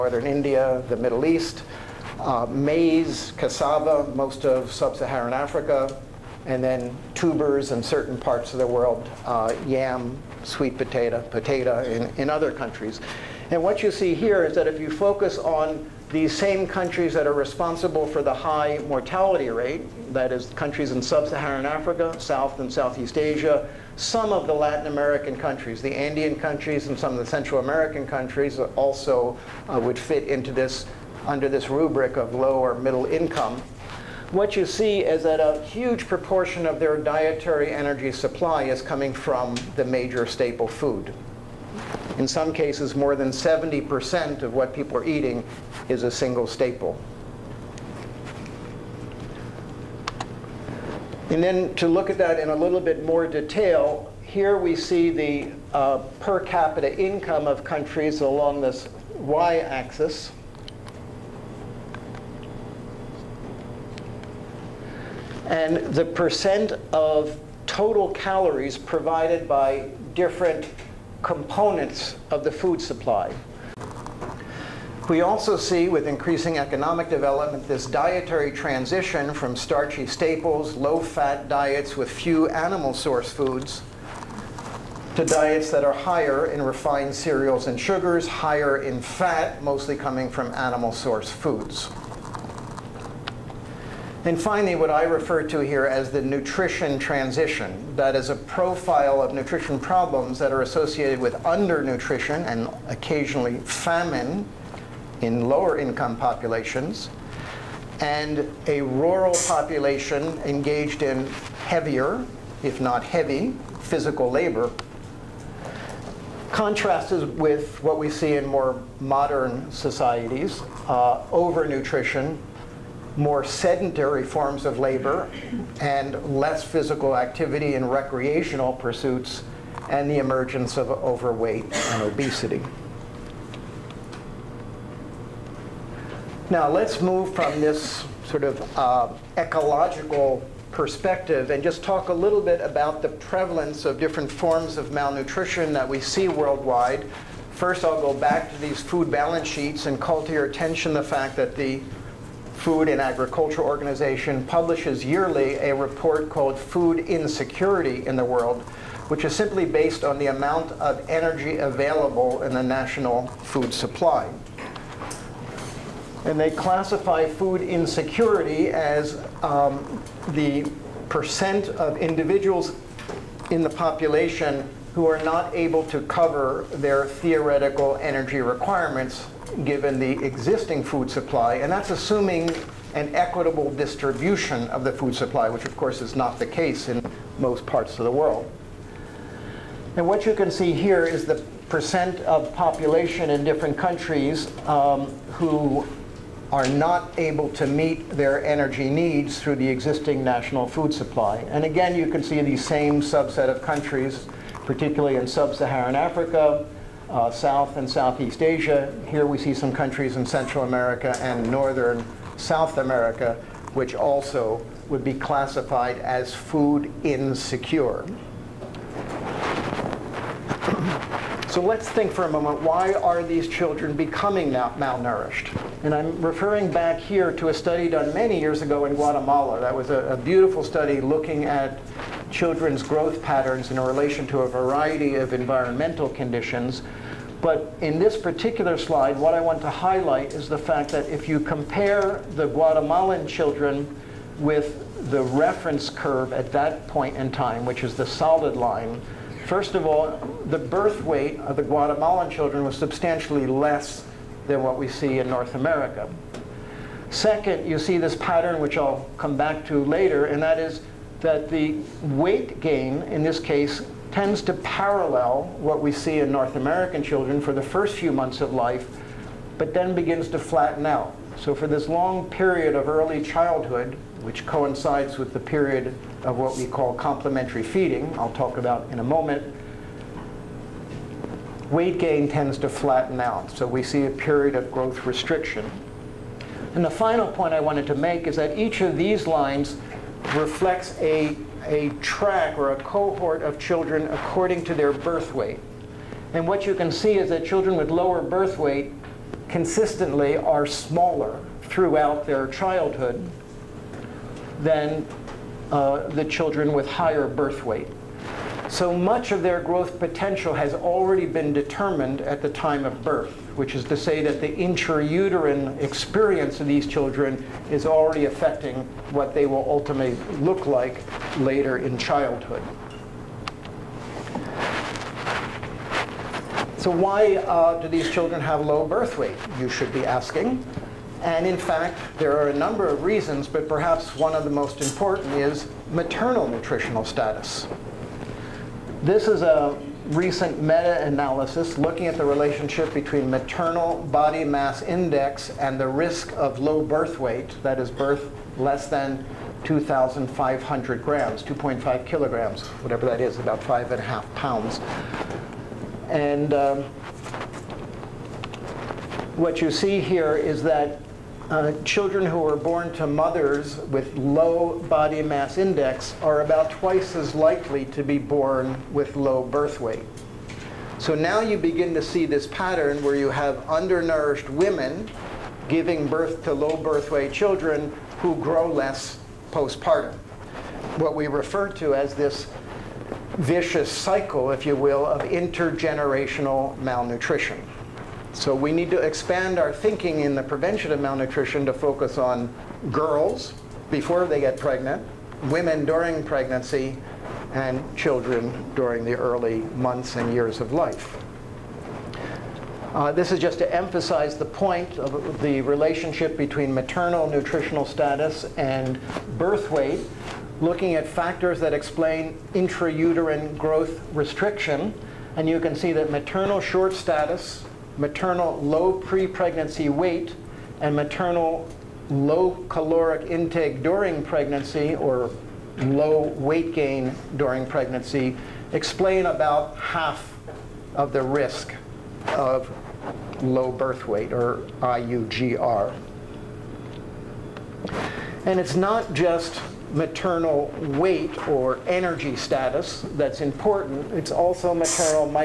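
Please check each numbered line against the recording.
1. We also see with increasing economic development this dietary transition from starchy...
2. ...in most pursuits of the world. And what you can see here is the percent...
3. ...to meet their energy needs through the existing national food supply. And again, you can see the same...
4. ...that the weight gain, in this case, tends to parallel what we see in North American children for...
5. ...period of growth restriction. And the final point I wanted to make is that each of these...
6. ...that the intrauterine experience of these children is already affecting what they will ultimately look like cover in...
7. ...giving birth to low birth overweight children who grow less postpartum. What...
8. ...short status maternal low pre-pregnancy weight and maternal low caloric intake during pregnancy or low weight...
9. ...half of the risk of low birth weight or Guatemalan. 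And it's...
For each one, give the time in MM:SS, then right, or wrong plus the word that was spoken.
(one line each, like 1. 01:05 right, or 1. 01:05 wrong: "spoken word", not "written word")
1. 01:15 right
2. 03:06 wrong: "parts", not "pursuits"
3. 03:17 right
4. 04:21 right
5. 04:44 right
6. 05:14 wrong: "later", not "cover"
7. 06:15 wrong: "weight", not "overweight"
8. 06:56 right
9. 07:09 wrong: "IUGR", not "Guatemalan".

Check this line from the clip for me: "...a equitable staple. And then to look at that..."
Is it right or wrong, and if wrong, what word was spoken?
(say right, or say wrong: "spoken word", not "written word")
wrong: "single", not "equitable".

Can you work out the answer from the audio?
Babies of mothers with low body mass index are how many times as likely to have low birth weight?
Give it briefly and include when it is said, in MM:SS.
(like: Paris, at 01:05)
about twice, at 06:06.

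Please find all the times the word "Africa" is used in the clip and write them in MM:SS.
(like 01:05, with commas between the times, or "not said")
00:05, 00:21, 03:25.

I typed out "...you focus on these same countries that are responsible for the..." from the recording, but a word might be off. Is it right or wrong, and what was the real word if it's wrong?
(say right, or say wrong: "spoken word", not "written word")
right.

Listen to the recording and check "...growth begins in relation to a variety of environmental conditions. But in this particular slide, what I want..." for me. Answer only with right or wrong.
wrong.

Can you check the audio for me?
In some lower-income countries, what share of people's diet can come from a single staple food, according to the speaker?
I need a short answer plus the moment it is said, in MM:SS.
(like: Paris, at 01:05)
more than 70%, at 00:42.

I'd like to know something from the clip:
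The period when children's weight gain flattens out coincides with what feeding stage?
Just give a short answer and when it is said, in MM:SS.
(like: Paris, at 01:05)
complementary feeding, at 04:36.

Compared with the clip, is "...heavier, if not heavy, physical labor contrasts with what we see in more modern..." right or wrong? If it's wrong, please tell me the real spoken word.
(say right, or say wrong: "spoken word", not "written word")
right.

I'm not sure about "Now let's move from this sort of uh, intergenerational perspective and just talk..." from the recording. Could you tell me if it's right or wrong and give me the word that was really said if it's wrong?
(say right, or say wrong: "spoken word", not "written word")
wrong: "ecological", not "intergenerational".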